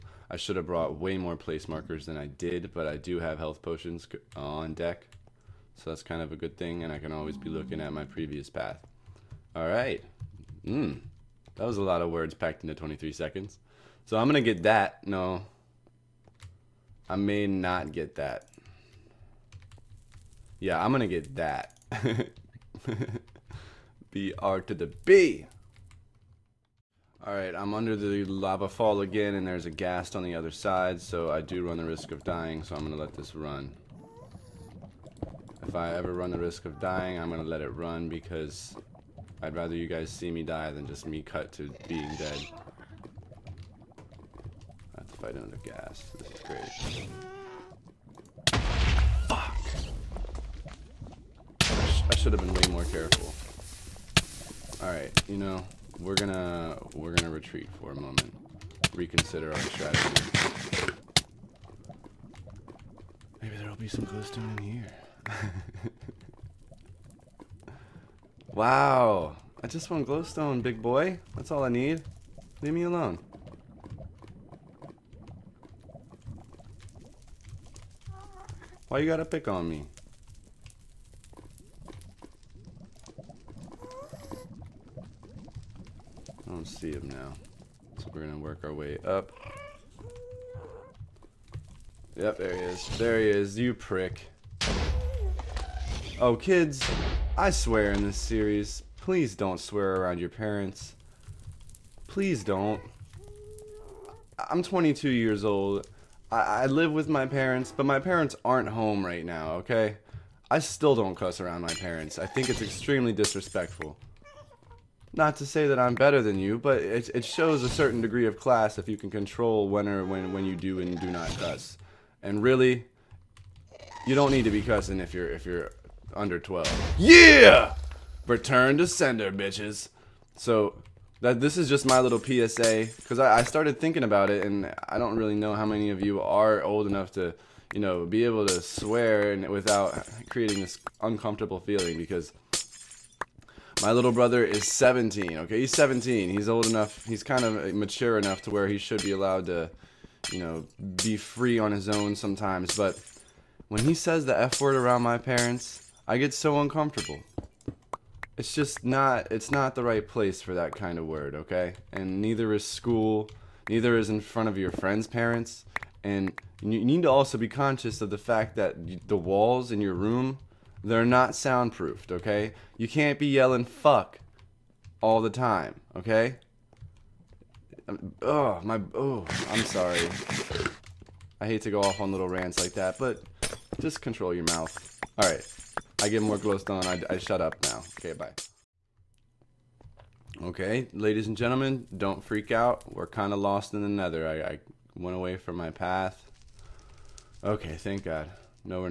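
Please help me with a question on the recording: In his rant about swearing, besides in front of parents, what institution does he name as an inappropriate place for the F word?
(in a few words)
school.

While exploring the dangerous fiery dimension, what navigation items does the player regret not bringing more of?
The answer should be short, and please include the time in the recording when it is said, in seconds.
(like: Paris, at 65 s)
place markers, at 1 s.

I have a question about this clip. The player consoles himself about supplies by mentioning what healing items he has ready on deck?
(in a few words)
health potions.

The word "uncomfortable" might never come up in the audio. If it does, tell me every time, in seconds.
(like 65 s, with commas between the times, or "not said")
141 s, 156 s.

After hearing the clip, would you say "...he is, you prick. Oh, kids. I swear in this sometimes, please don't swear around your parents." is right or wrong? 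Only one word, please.
wrong.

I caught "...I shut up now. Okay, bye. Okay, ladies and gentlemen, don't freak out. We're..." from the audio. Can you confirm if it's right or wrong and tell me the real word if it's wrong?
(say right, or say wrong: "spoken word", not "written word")
right.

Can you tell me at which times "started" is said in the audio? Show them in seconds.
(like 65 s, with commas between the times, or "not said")
133 s.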